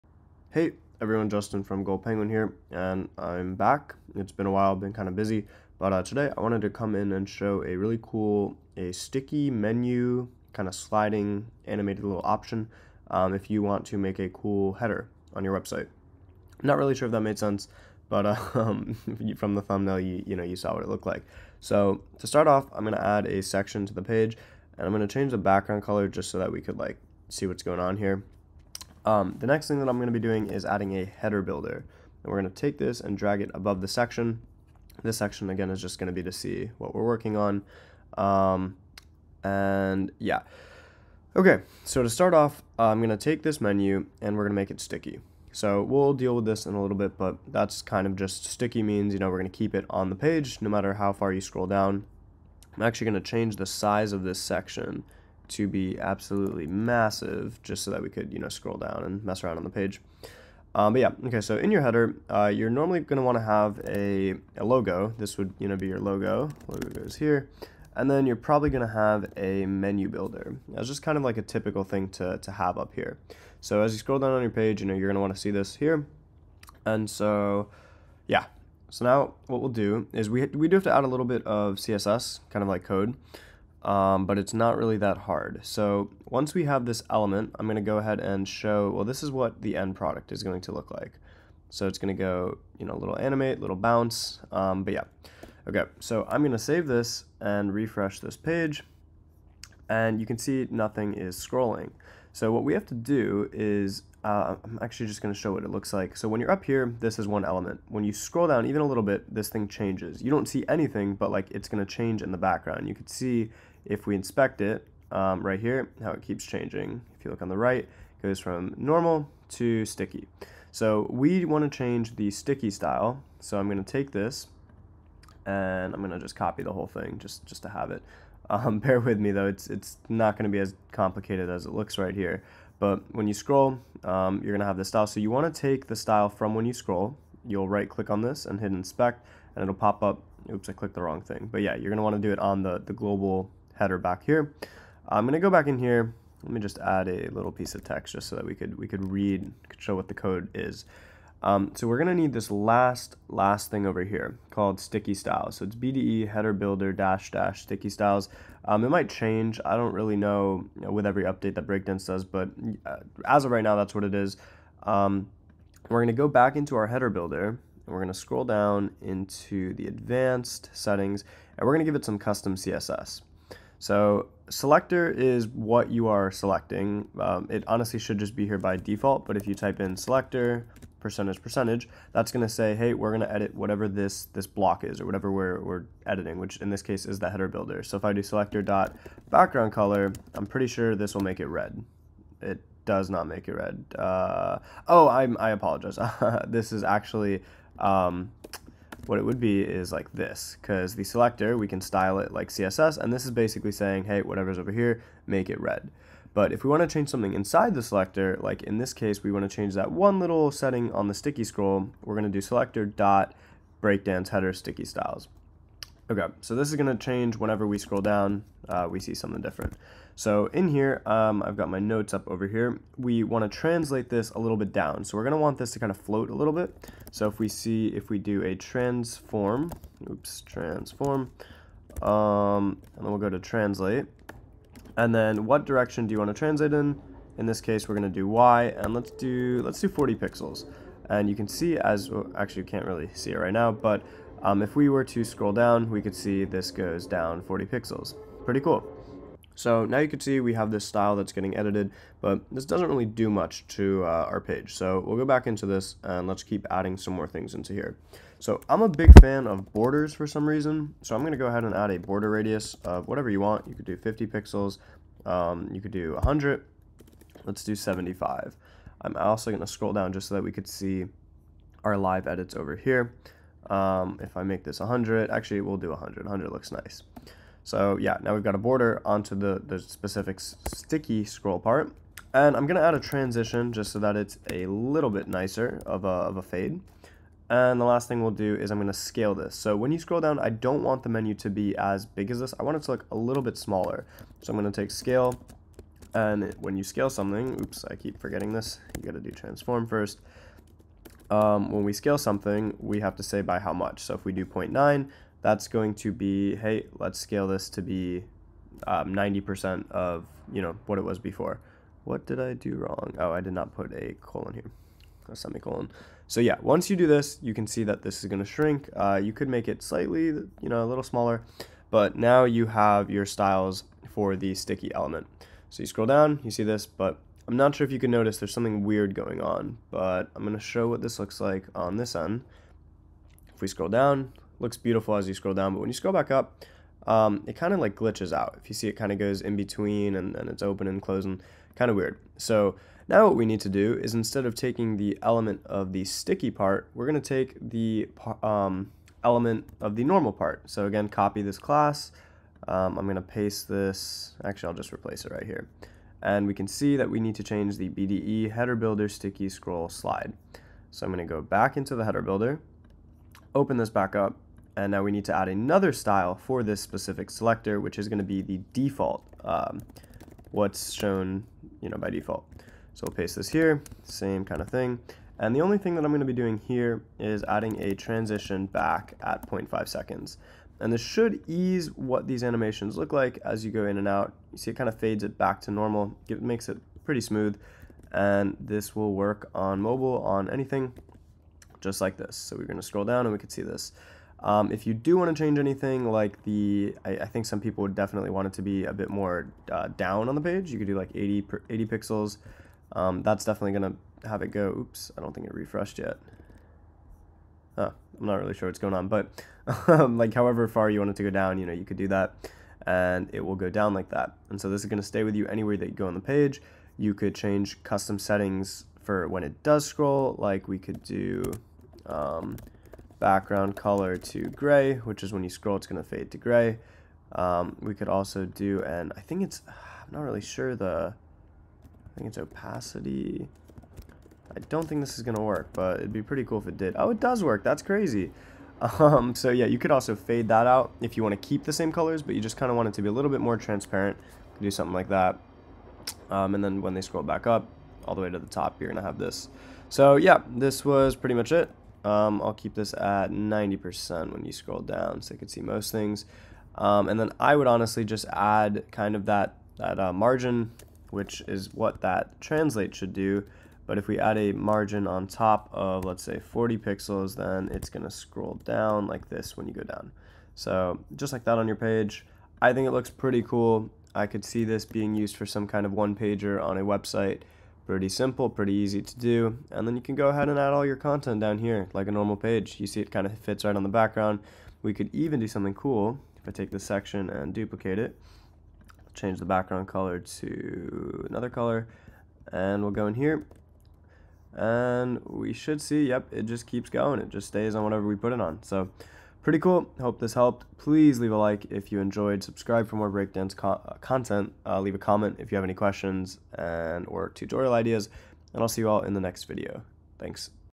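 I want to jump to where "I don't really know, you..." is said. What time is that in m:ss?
2:39.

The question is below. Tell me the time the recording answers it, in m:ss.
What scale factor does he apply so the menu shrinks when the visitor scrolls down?
5:04.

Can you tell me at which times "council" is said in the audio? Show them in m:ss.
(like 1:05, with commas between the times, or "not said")
not said.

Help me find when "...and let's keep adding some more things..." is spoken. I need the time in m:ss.
4:16.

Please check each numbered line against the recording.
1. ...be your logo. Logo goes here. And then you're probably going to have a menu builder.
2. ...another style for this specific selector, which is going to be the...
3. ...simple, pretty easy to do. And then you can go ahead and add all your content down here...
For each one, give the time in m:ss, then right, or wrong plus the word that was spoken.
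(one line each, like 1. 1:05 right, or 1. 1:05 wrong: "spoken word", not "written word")
1. 1:05 right
2. 6:05 right
3. 7:58 right.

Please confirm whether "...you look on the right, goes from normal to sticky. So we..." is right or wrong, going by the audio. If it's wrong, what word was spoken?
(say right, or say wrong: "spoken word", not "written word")
right.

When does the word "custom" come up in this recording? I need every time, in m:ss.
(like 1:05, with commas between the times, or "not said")
2:52, 6:57.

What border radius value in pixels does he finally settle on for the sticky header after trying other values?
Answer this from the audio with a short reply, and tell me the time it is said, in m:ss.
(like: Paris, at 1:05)
100, at 4:36.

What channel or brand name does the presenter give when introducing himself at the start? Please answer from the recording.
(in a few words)
Gold Penguin.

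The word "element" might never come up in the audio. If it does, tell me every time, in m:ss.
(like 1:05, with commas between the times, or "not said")
1:27, 1:47, 5:24, 5:45, 5:49.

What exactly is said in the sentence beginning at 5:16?
So yeah, once you do this, you can see that this is gonna shrink.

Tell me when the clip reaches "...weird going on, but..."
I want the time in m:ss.
5:28.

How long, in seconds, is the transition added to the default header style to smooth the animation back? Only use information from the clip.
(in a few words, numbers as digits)
0.5 seconds.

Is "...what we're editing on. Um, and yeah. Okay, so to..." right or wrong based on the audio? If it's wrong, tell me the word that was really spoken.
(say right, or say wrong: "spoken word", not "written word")
wrong: "working", not "editing".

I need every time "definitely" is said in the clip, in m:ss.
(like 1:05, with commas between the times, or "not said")
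6:37, 6:43.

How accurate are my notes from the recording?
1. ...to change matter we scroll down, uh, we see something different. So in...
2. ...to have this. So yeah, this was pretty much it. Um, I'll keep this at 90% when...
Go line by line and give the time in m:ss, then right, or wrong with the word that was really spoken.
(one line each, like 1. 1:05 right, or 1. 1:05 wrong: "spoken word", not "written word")
1. 3:36 wrong: "whenever", not "matter"
2. 7:28 right.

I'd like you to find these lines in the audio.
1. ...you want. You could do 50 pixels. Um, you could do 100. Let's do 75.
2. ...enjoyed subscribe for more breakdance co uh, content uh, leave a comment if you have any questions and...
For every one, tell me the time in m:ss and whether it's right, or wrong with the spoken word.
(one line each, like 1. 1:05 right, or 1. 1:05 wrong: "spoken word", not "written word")
1. 4:23 right
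2. 8:21 right.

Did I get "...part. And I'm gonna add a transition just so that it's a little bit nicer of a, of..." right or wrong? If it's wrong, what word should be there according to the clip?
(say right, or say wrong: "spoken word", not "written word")
right.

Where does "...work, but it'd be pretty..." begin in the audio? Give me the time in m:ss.
7:15.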